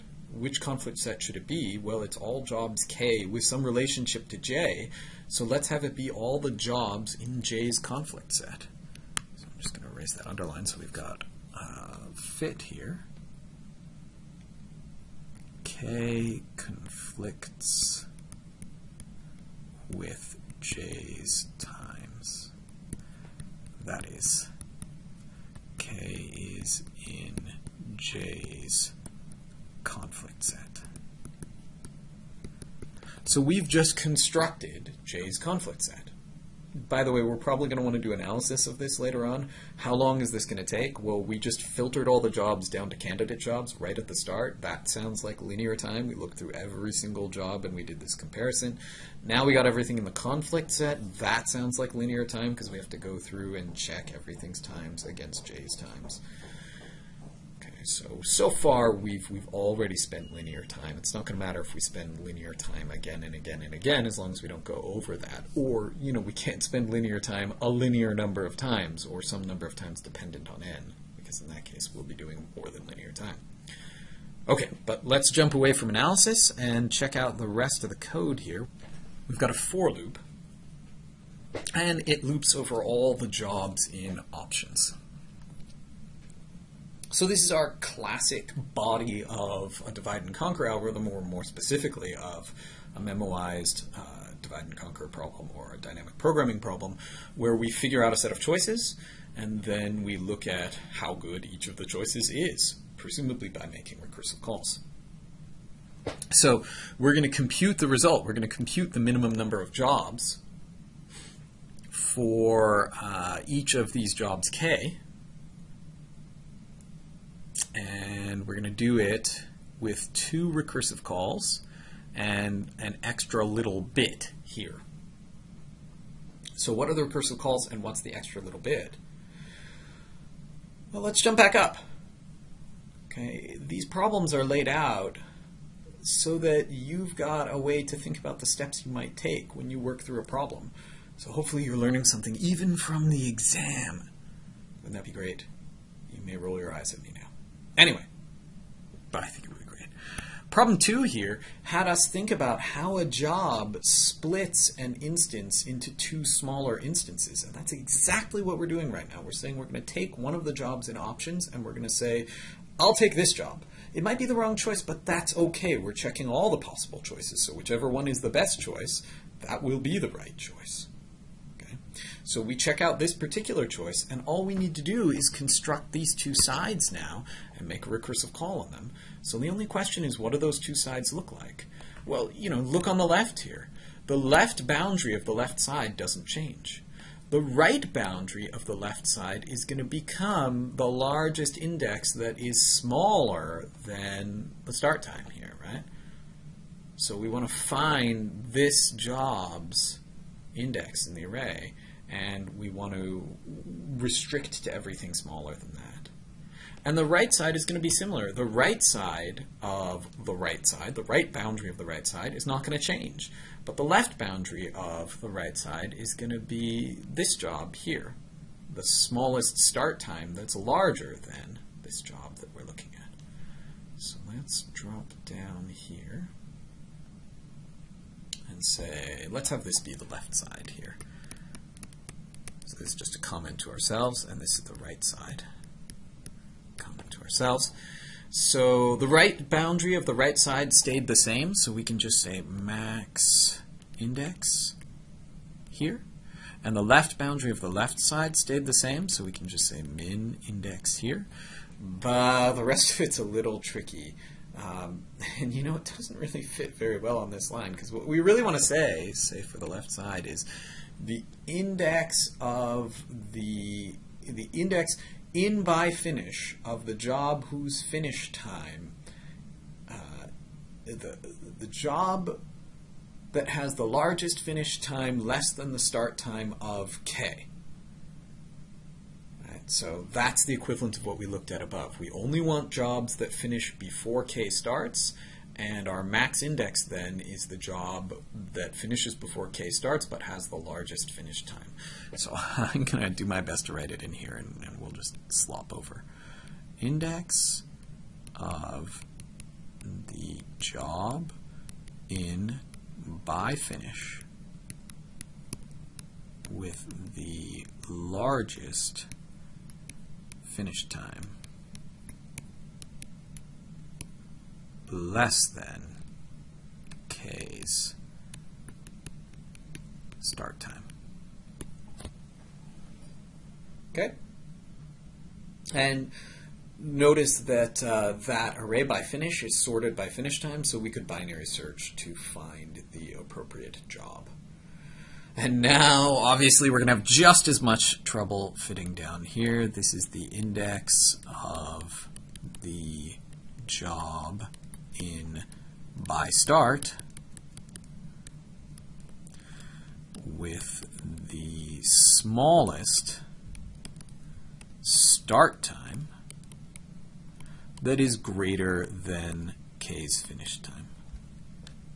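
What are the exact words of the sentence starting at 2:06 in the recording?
So what are the recursive calls and what's the extra little bit?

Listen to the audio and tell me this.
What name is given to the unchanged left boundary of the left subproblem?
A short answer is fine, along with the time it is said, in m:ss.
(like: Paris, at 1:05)
min index, at 4:09.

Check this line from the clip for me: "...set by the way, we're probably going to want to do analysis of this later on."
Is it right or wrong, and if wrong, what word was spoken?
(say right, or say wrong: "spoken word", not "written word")
right.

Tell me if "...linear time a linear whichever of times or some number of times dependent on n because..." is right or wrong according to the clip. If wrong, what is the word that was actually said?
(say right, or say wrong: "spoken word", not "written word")
wrong: "number", not "whichever".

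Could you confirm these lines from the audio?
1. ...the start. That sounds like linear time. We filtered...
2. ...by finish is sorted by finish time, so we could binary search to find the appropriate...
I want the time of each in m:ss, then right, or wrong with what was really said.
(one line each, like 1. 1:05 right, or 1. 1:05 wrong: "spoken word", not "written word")
1. 0:44 wrong: "looked", not "filtered"
2. 5:28 right.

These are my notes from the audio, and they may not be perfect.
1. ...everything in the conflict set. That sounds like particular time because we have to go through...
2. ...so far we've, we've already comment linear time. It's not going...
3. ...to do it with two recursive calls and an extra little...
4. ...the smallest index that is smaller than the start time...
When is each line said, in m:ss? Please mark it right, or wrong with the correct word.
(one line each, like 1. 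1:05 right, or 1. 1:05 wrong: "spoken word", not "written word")
1. 0:49 wrong: "linear", not "particular"
2. 0:58 wrong: "spent", not "comment"
3. 1:58 right
4. 3:10 wrong: "largest", not "smallest".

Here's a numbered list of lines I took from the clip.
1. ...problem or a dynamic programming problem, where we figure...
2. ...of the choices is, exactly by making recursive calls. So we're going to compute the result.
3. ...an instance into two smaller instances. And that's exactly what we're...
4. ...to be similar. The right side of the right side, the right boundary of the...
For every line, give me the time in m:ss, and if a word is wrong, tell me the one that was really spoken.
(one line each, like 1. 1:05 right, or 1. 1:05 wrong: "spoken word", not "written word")
1. 1:35 right
2. 1:41 wrong: "presumably", not "exactly"
3. 2:34 right
4. 3:27 right.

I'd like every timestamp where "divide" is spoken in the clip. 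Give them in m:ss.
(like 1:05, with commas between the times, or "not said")
1:29, 1:34.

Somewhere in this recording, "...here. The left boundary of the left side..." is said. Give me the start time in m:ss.
3:03.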